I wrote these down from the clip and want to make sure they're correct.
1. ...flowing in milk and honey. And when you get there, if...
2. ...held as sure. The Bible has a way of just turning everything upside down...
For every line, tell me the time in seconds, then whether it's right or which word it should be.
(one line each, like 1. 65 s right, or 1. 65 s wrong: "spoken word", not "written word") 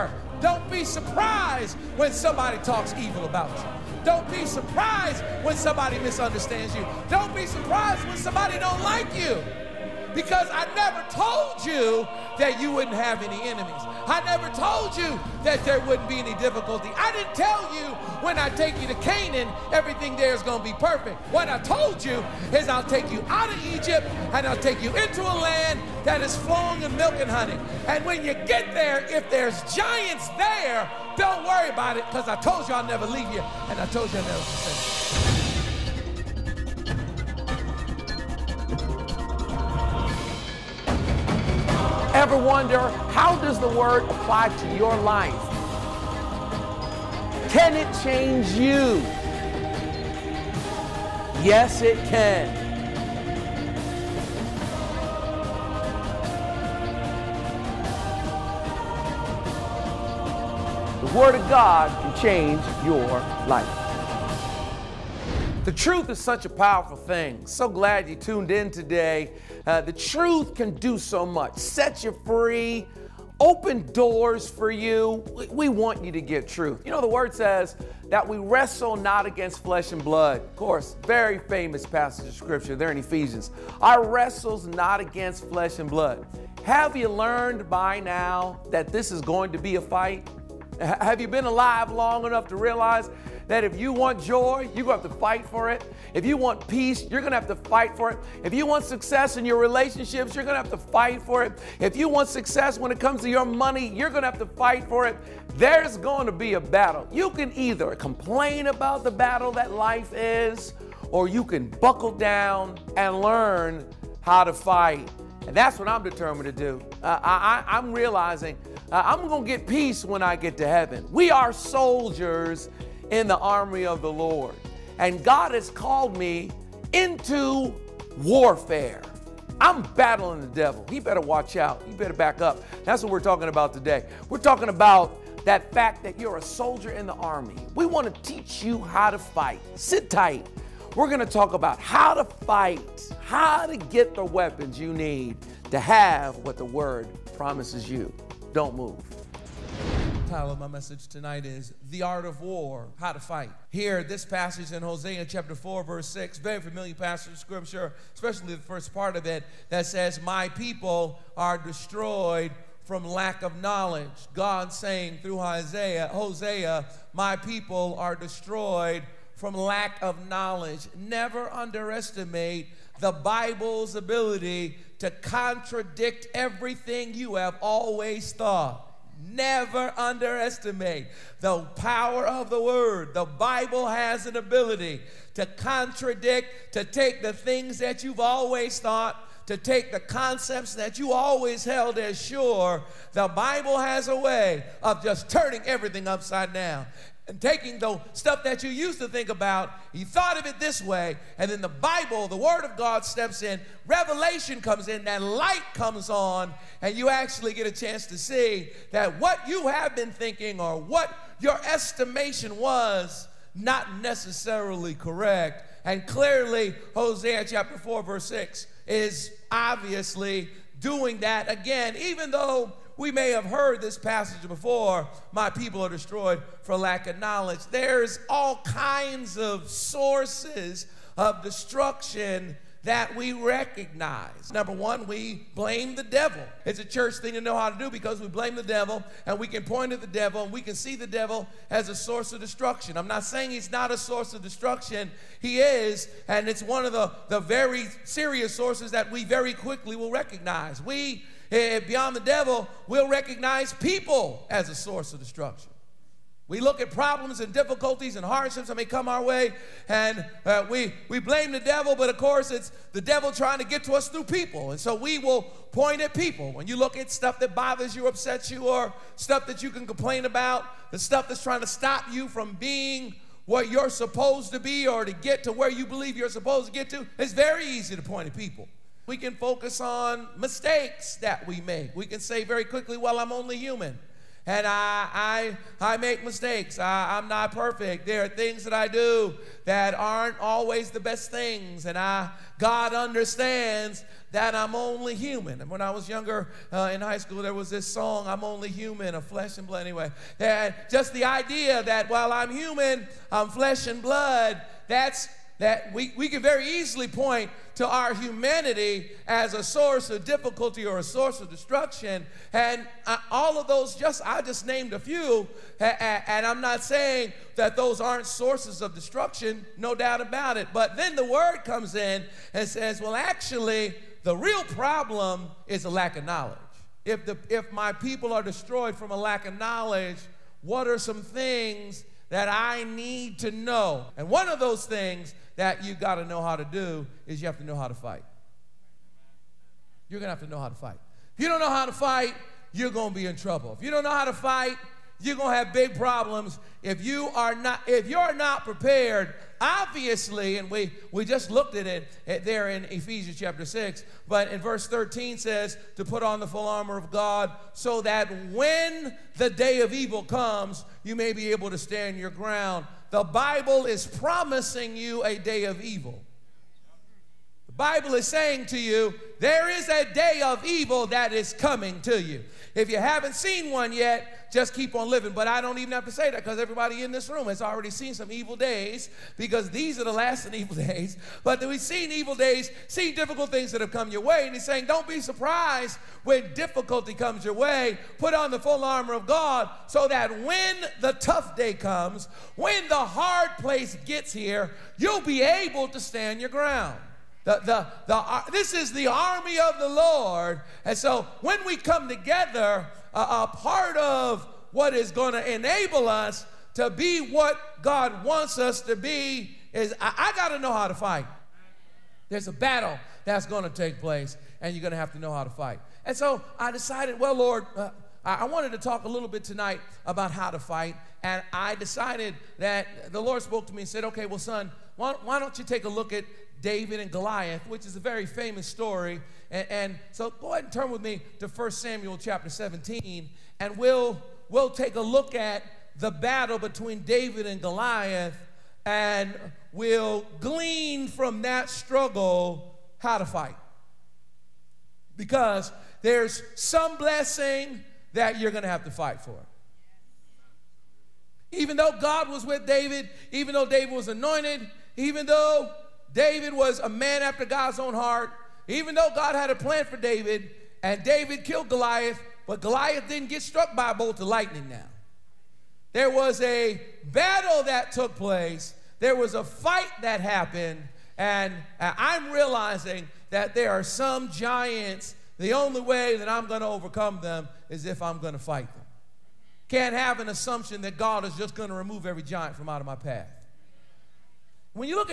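1. 26 s right
2. 191 s right.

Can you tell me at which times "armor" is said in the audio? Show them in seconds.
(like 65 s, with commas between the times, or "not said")
356 s, 388 s.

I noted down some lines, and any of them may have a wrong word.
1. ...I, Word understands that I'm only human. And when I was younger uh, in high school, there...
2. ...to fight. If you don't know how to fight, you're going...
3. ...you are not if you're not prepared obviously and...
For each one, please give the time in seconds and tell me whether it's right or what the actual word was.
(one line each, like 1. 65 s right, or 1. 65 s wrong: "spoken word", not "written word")
1. 291 s wrong: "God", not "Word"
2. 340 s right
3. 347 s right.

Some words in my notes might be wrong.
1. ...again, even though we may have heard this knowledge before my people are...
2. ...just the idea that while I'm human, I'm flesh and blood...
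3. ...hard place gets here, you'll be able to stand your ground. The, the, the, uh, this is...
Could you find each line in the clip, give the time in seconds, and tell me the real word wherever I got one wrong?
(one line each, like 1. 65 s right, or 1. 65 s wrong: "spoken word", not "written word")
1. 221 s wrong: "passage", not "knowledge"
2. 300 s right
3. 392 s right.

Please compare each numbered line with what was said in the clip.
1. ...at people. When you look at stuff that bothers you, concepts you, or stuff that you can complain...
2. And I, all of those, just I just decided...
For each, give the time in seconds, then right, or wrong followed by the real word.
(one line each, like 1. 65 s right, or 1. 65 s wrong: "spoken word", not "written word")
1. 266 s wrong: "upsets", not "concepts"
2. 312 s wrong: "named", not "decided".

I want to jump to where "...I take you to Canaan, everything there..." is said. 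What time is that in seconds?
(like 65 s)
18 s.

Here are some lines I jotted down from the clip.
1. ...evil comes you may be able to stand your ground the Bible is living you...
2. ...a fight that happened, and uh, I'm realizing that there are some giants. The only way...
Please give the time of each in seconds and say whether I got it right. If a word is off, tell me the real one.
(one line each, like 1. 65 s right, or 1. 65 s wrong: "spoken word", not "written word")
1. 359 s wrong: "promising", not "living"
2. 469 s right.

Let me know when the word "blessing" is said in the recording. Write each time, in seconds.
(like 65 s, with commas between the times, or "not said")
446 s.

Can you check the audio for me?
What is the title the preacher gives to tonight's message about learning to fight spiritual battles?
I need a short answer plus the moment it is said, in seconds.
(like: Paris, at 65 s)
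The Art of War How to Fight, at 151 s.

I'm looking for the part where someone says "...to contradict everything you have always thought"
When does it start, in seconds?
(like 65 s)
174 s.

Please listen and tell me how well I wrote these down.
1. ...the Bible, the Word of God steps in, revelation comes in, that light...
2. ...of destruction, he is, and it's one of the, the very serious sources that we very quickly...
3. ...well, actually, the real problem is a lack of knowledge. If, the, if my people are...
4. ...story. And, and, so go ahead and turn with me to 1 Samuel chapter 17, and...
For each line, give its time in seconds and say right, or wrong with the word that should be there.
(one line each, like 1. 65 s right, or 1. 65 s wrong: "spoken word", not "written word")
1. 201 s right
2. 244 s right
3. 322 s right
4. 428 s right.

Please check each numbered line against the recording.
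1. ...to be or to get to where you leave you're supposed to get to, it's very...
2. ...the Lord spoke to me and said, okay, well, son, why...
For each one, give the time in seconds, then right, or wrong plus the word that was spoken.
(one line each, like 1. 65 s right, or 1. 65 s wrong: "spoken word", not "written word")
1. 274 s wrong: "believe", not "leave"
2. 423 s right.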